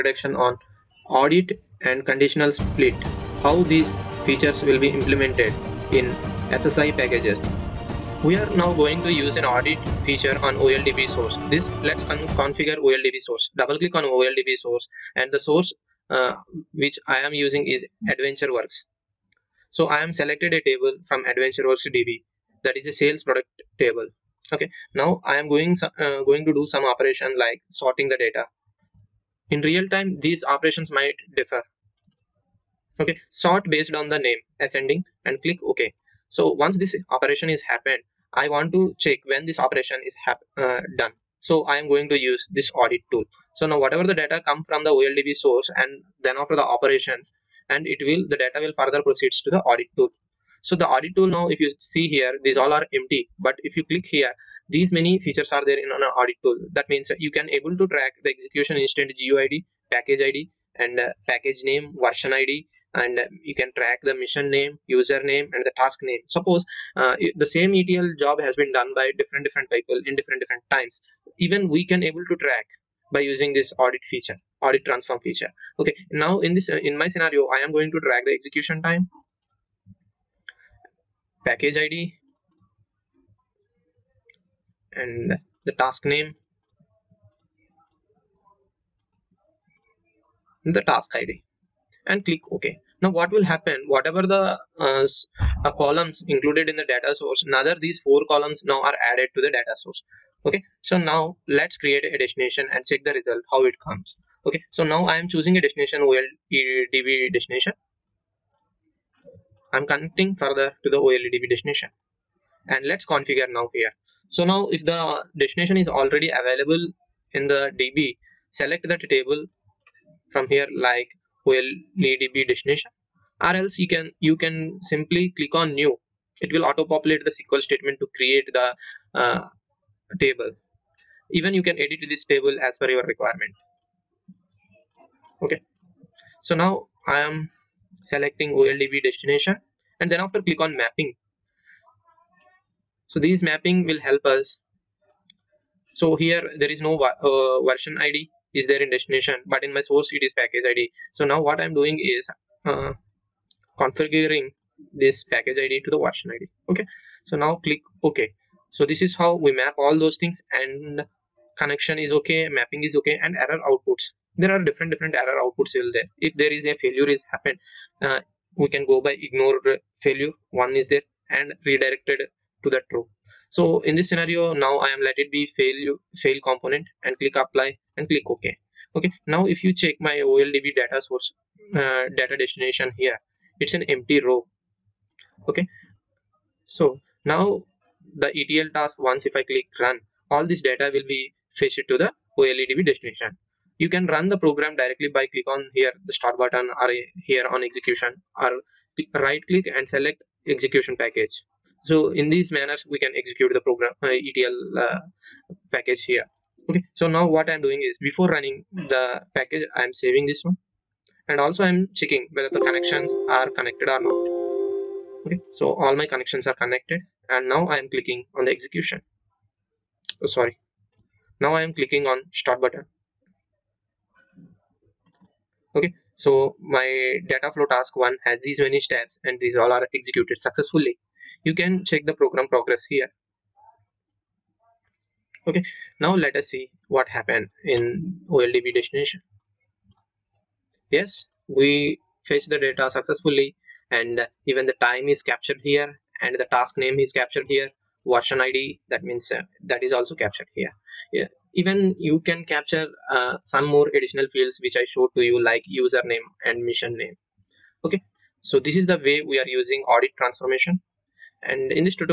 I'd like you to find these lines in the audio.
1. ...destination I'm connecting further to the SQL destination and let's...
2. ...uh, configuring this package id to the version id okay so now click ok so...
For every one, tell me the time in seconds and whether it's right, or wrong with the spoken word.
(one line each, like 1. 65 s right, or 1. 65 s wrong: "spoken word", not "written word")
1. 107 s wrong: "OLEDB", not "SQL"
2. 152 s right.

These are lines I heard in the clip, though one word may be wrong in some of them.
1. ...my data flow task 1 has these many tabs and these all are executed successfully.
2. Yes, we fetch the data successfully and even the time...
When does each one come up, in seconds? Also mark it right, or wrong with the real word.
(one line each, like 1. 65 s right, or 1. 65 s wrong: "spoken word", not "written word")
1. 226 s right
2. 240 s right.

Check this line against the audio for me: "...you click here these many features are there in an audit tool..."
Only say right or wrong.
right.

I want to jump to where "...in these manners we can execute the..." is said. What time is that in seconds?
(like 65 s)
202 s.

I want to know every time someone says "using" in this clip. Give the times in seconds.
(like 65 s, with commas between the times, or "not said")
17 s, 73 s, 259 s.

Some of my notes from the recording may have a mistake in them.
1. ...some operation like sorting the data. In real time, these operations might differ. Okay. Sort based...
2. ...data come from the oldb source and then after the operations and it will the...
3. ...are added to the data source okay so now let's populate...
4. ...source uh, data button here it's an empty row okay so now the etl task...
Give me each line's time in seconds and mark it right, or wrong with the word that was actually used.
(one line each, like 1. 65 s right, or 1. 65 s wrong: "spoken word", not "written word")
1. 26 s right
2. 44 s right
3. 98 s wrong: "create", not "populate"
4. 181 s wrong: "destination", not "button".